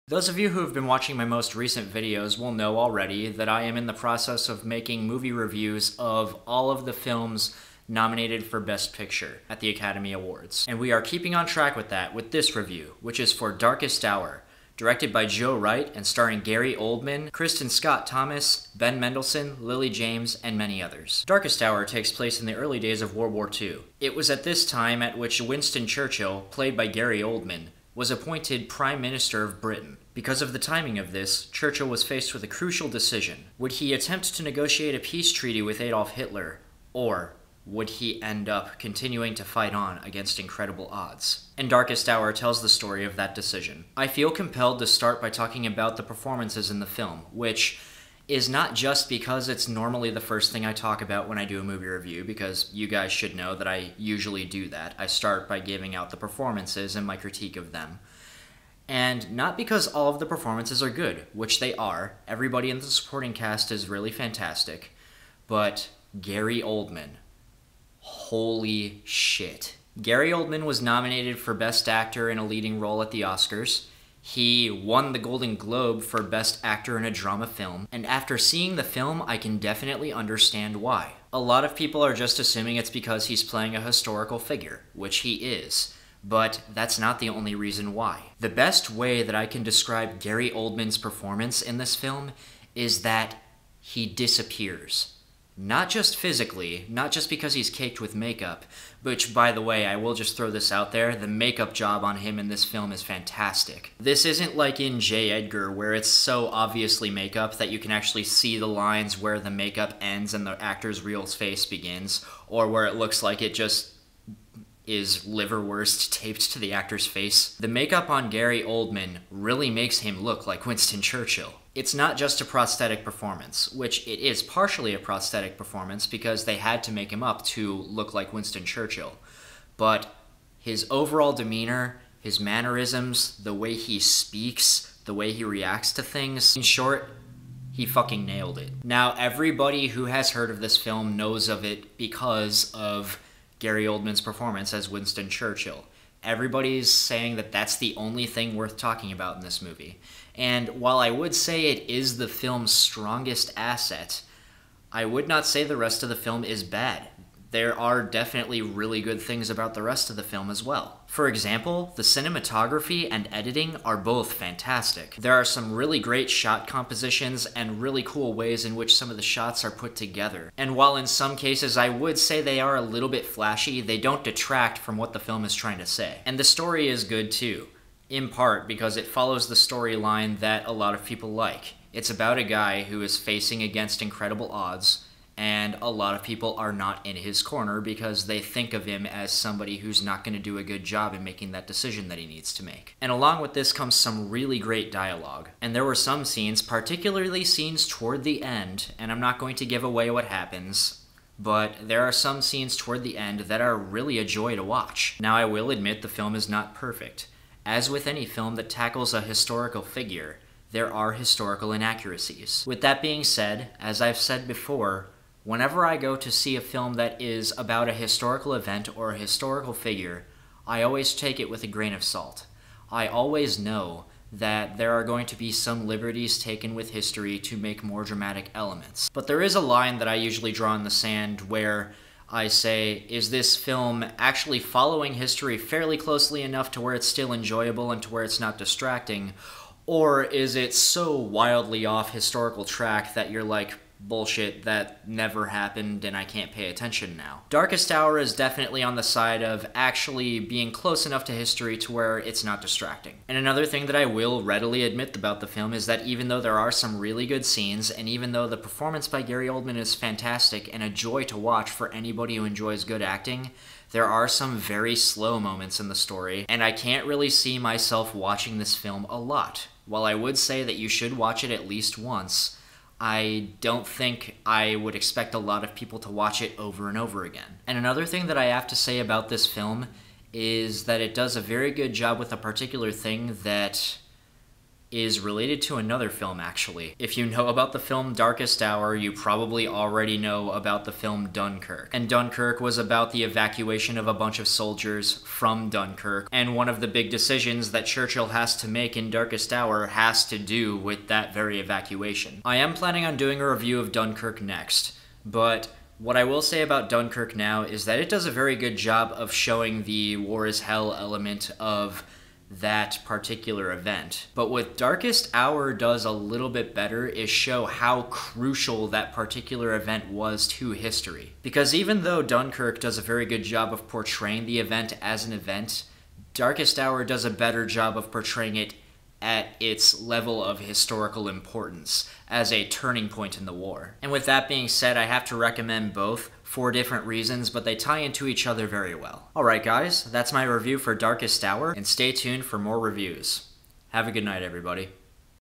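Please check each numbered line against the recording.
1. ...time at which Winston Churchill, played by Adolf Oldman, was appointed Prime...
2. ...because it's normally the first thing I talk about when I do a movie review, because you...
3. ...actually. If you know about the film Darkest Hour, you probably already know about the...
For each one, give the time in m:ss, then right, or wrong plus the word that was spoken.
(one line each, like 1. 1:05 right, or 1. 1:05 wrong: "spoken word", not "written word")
1. 0:24 wrong: "Gary", not "Adolf"
2. 0:49 right
3. 4:46 right.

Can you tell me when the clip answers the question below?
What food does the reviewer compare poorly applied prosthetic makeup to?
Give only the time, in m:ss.
1:55.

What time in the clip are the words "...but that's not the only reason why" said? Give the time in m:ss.
1:26.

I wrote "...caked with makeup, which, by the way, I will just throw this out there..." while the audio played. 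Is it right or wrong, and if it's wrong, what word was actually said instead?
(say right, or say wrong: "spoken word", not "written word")
right.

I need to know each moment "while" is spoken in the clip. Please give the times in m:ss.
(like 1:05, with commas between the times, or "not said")
2:30, 2:50, 4:29.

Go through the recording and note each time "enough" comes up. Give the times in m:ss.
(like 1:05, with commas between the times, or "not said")
3:56, 4:11.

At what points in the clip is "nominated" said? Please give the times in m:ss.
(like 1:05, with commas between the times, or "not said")
0:07, 1:10.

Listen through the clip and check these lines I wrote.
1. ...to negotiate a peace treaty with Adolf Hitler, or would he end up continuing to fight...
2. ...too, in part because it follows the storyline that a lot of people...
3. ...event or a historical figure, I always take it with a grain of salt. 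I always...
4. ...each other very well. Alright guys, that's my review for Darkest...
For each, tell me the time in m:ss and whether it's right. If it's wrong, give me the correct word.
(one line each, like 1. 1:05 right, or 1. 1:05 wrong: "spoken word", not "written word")
1. 0:34 right
2. 2:57 right
3. 3:38 right
4. 5:38 right.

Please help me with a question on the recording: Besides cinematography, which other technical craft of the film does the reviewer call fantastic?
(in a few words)
Editing.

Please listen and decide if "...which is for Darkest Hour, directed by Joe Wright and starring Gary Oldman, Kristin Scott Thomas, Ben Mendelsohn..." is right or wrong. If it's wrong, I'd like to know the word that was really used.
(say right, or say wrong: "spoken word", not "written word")
right.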